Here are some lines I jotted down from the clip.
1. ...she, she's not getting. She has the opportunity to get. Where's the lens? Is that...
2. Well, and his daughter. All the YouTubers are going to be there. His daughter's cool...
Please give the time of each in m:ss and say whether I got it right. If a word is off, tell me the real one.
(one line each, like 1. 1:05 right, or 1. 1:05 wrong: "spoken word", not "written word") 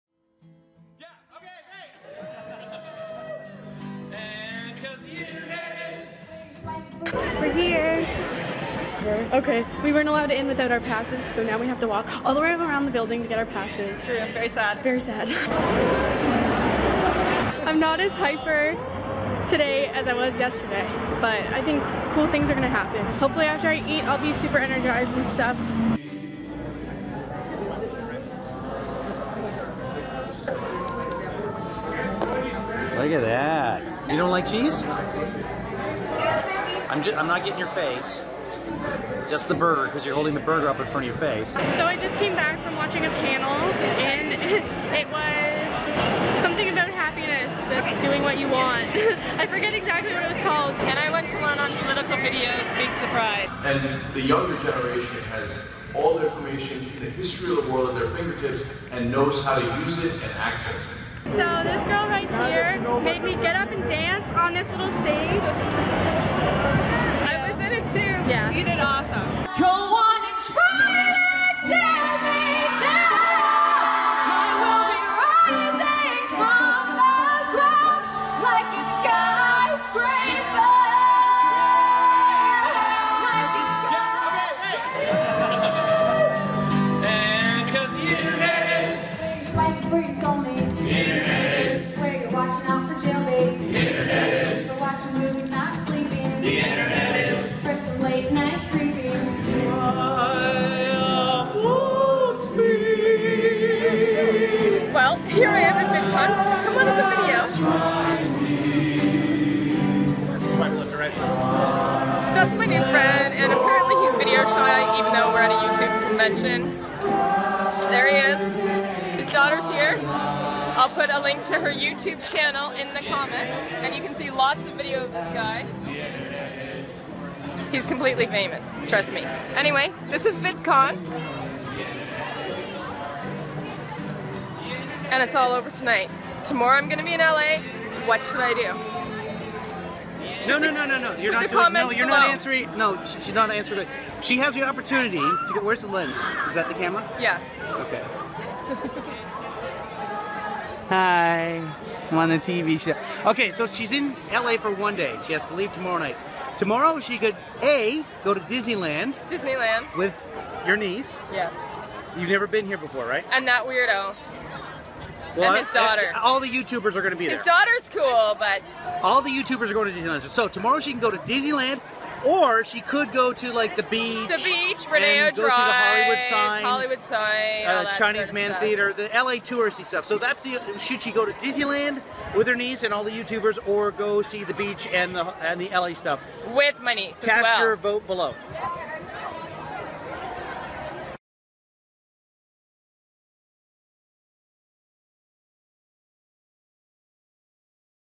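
1. 2:23 wrong: "answering", not "getting"
2. 2:45 right.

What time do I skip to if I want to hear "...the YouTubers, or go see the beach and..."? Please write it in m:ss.
3:03.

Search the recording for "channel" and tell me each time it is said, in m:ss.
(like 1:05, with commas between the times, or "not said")
2:02.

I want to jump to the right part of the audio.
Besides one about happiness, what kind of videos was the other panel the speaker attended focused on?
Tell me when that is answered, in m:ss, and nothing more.
0:51.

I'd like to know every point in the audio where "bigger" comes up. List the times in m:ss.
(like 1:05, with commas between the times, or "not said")
not said.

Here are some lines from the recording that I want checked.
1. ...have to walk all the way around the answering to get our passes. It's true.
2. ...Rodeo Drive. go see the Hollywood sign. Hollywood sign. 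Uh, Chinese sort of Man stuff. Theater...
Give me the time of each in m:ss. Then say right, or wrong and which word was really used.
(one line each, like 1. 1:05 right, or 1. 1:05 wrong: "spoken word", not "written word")
1. 0:11 wrong: "building", not "answering"
2. 2:54 right.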